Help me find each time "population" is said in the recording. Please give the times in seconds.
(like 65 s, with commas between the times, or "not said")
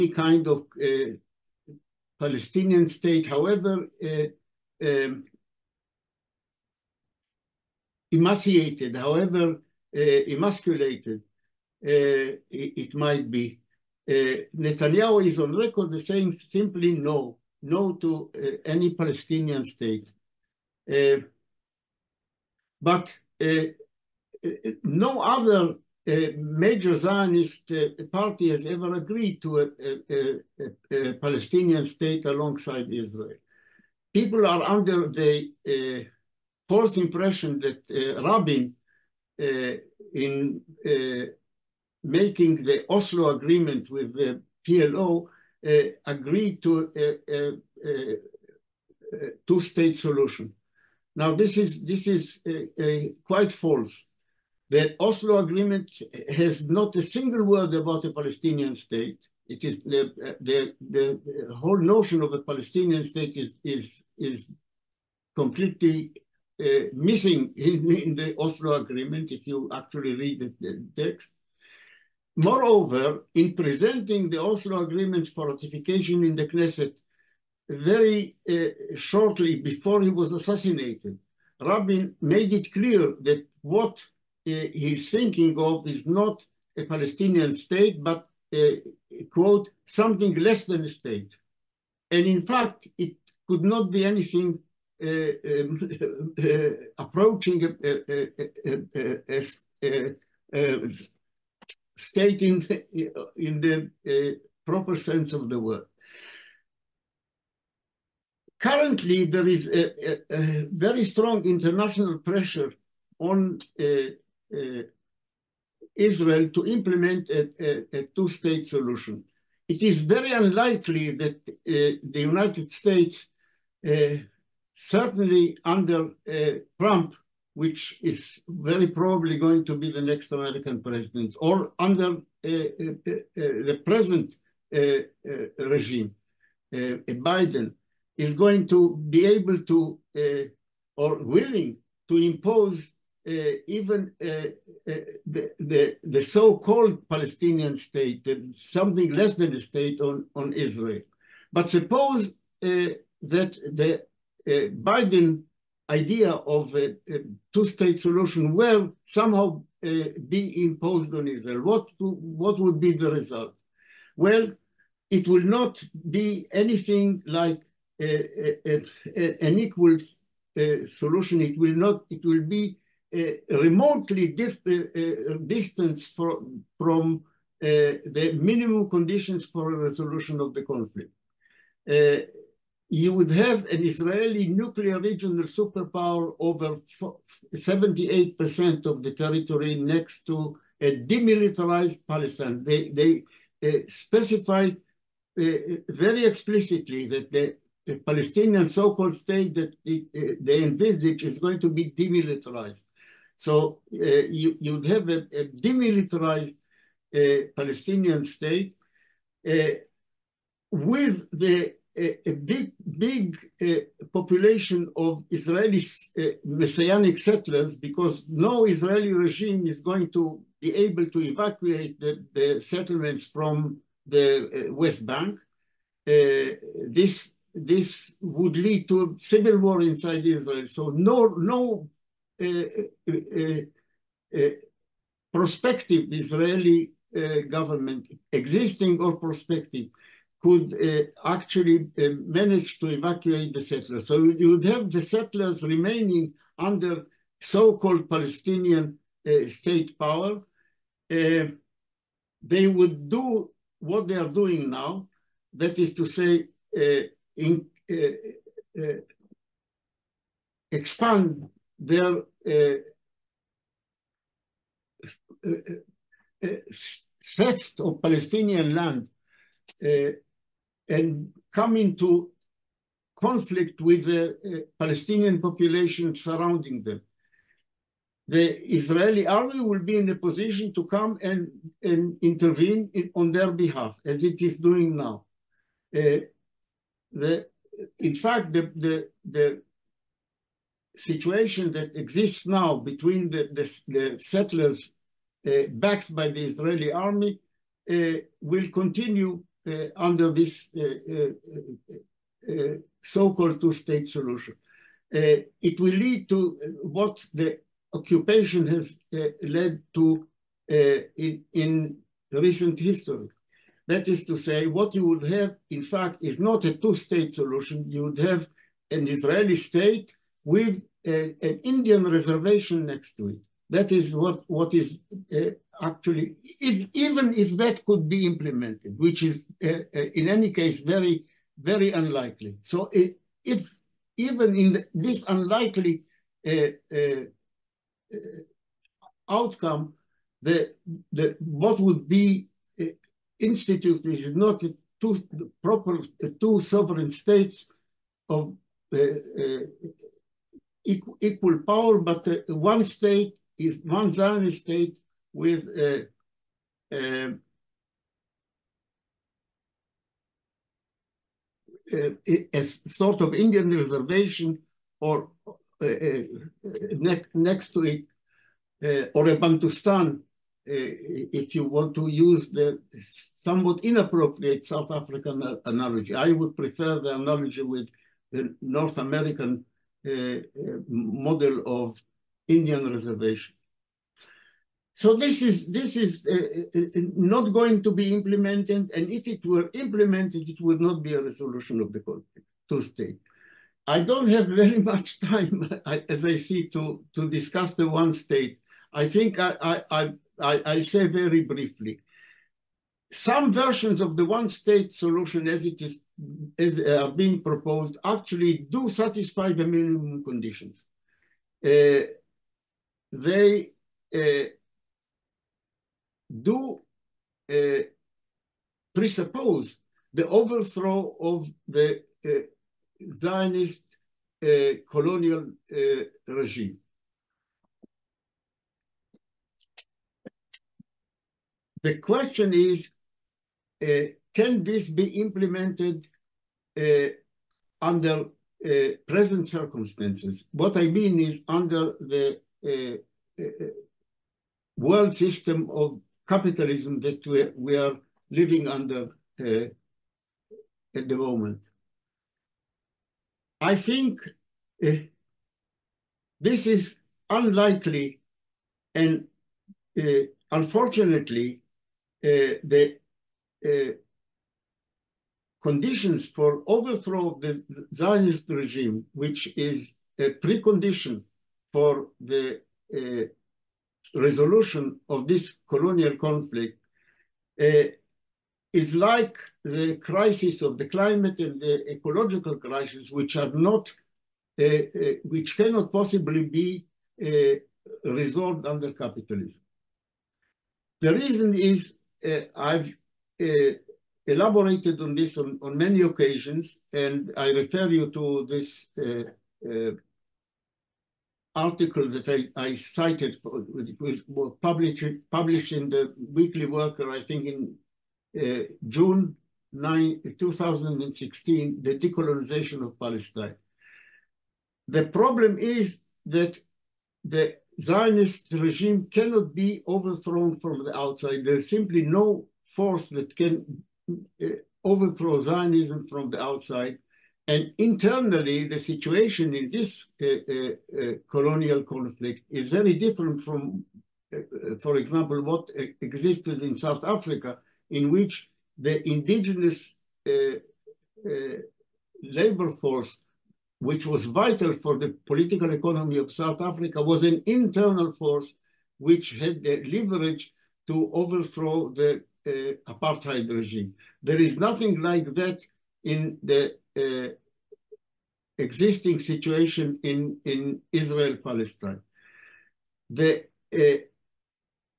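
214 s, 275 s.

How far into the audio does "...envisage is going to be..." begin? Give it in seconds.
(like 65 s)
200 s.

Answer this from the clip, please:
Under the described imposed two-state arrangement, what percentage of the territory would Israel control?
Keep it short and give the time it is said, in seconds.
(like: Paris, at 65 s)
78%, at 187 s.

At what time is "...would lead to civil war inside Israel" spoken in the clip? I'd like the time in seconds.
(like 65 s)
228 s.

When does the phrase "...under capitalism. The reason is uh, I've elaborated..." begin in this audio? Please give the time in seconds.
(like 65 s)
488 s.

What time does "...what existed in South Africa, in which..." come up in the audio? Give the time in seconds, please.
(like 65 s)
535 s.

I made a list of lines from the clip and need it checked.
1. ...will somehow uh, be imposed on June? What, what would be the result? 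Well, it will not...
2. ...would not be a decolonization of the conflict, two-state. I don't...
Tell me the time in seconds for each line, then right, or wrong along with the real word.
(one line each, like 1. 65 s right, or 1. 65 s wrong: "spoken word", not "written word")
1. 158 s wrong: "Israel", not "June"
2. 390 s wrong: "resolution", not "decolonization".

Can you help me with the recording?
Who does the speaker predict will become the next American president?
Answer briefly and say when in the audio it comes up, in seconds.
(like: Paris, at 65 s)
Trump, at 126 s.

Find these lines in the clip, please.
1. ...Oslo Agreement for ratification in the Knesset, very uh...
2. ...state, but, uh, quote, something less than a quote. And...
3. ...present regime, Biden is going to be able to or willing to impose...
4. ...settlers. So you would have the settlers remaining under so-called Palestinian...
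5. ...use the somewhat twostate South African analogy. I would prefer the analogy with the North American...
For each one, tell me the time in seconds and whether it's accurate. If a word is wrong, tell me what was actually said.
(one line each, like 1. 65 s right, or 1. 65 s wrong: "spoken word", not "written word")
1. 74 s right
2. 87 s wrong: "state", not "quote"
3. 133 s right
4. 243 s right
5. 372 s wrong: "inappropriate", not "twostate".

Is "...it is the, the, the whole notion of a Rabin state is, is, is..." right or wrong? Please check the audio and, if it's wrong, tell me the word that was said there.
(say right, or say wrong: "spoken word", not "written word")
wrong: "Palestinian", not "Rabin".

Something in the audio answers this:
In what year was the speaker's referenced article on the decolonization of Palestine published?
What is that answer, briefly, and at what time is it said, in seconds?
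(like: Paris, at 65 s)
2016, at 510 s.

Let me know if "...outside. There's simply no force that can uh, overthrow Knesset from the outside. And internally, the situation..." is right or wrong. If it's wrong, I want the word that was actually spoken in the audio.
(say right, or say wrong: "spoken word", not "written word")
wrong: "Zionism", not "Knesset".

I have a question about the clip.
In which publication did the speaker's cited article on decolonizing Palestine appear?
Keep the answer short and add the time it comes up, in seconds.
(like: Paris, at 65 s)
Weekly Worker, at 506 s.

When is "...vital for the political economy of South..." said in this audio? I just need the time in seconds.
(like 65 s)
544 s.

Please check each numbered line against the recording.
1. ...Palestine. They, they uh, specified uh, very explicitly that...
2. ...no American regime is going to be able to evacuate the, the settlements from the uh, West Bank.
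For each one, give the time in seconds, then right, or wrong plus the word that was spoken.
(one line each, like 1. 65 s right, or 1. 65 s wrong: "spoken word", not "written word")
1. 192 s right
2. 218 s wrong: "Israeli", not "American".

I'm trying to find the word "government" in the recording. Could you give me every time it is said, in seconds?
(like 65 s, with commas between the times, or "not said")
237 s.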